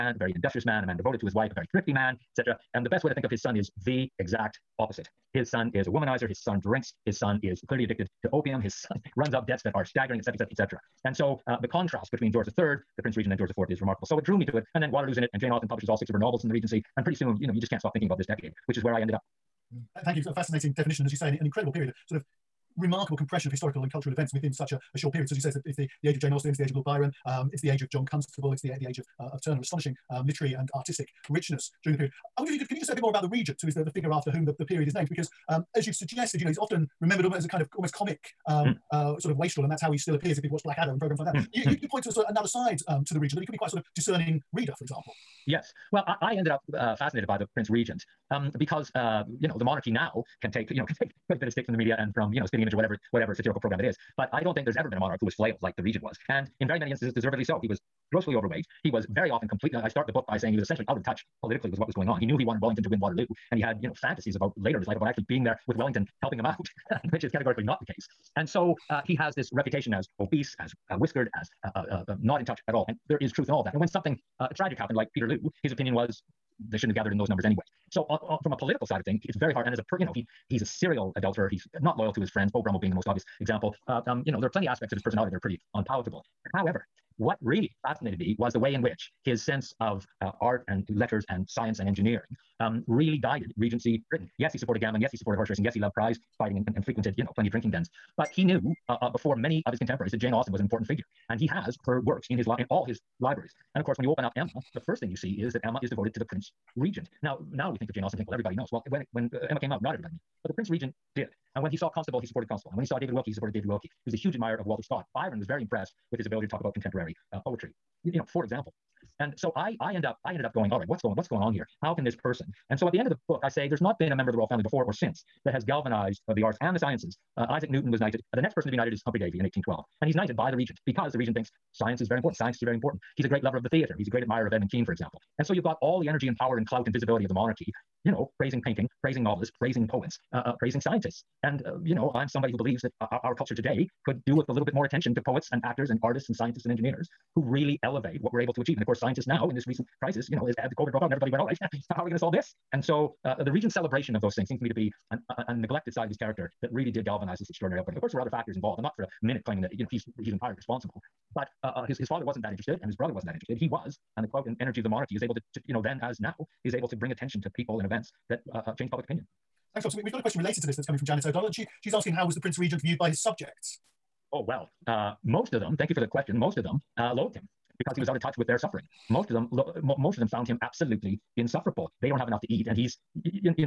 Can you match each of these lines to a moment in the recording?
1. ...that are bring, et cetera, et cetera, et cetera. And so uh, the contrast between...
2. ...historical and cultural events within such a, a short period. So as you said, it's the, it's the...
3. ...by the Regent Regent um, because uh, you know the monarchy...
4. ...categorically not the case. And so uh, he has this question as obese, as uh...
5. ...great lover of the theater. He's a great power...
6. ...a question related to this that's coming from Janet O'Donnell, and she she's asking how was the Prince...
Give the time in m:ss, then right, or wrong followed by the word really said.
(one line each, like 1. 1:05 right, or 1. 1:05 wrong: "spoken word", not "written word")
1. 0:09 wrong: "staggering", not "bring"
2. 0:23 right
3. 0:47 wrong: "Prince", not "Regent"
4. 1:07 wrong: "reputation", not "question"
5. 2:13 wrong: "admirer", not "power"
6. 2:50 right.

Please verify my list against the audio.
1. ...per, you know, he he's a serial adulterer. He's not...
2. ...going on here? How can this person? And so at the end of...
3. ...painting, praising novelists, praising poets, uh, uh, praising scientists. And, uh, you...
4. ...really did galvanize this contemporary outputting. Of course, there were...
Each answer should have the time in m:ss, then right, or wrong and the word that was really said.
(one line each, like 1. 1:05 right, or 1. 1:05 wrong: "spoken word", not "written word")
1. 1:19 right
2. 2:01 right
3. 2:18 right
4. 2:36 wrong: "extraordinary", not "contemporary".